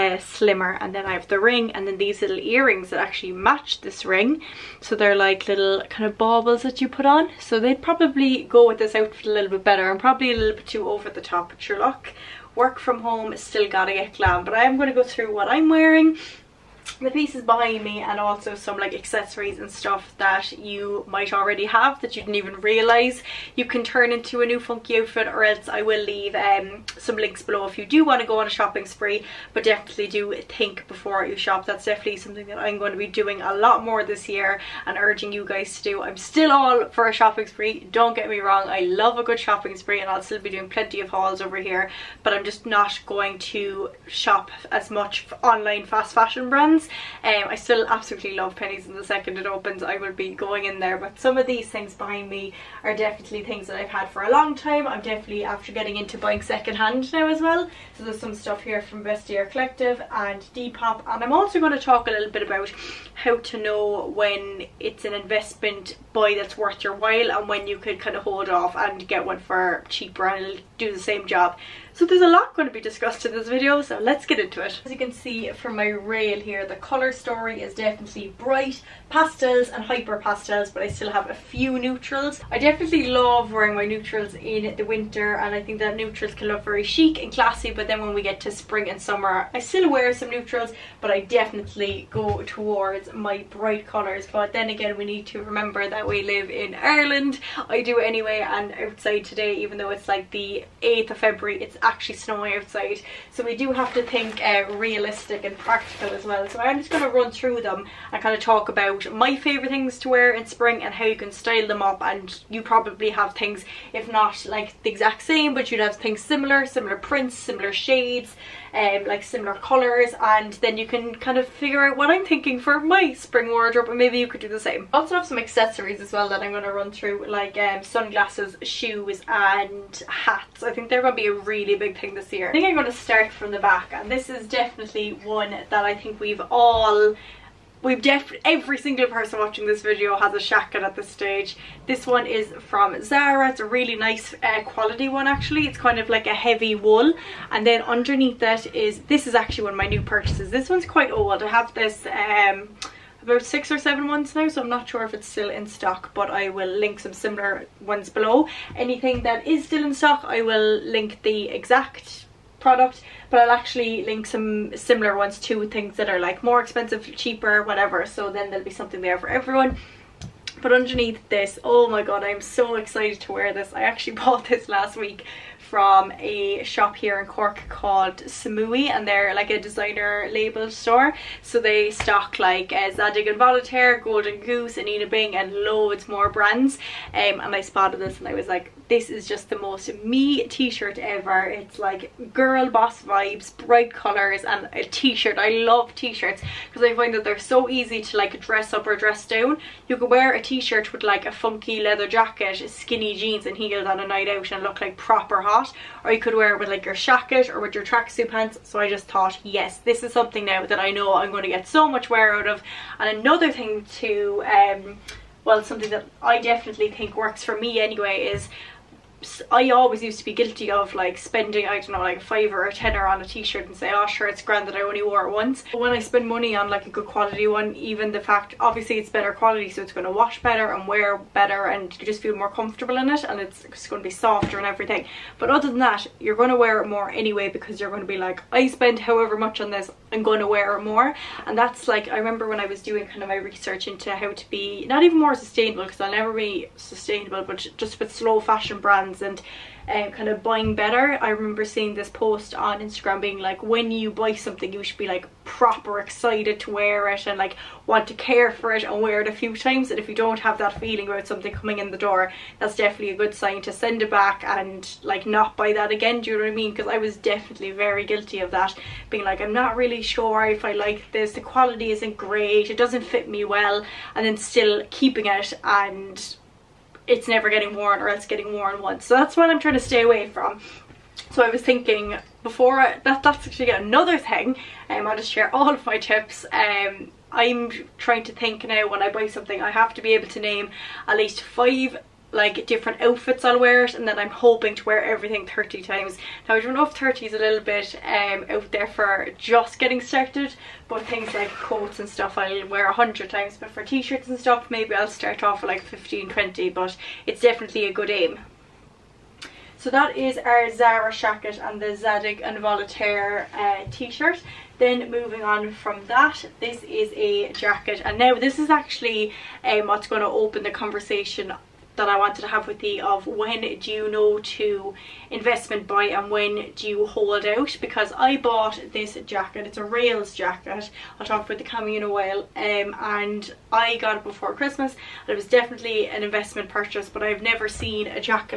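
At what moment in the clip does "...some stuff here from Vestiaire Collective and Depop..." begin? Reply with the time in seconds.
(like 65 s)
58 s.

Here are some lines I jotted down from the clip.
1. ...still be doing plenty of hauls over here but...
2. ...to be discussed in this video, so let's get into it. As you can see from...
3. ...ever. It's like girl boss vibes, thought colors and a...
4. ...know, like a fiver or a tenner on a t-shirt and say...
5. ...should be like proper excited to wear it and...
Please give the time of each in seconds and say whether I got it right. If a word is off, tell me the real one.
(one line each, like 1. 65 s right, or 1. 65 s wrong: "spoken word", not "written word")
1. 40 s right
2. 72 s right
3. 190 s wrong: "bright", not "thought"
4. 221 s right
5. 254 s right.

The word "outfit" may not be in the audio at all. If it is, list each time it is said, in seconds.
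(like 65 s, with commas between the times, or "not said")
8 s, 24 s, 292 s.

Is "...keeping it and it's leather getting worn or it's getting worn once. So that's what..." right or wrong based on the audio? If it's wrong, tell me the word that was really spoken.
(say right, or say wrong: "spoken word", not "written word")
wrong: "never", not "leather".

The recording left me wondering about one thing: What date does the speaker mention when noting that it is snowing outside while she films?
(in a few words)
8th of February.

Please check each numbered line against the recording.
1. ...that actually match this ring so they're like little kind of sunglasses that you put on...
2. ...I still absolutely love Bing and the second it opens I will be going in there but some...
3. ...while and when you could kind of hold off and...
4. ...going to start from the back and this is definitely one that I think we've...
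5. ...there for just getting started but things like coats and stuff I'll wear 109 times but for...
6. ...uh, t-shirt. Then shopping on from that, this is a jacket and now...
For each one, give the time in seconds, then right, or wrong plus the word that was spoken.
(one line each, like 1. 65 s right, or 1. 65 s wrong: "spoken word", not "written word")
1. 2 s wrong: "baubles", not "sunglasses"
2. 47 s wrong: "Penneys", not "Bing"
3. 66 s right
4. 132 s right
5. 298 s wrong: "100", not "109"
6. 313 s wrong: "moving", not "shopping".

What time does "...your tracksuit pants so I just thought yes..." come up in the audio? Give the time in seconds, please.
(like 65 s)
207 s.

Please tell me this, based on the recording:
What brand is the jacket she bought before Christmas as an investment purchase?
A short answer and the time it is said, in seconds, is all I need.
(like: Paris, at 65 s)
Rails, at 329 s.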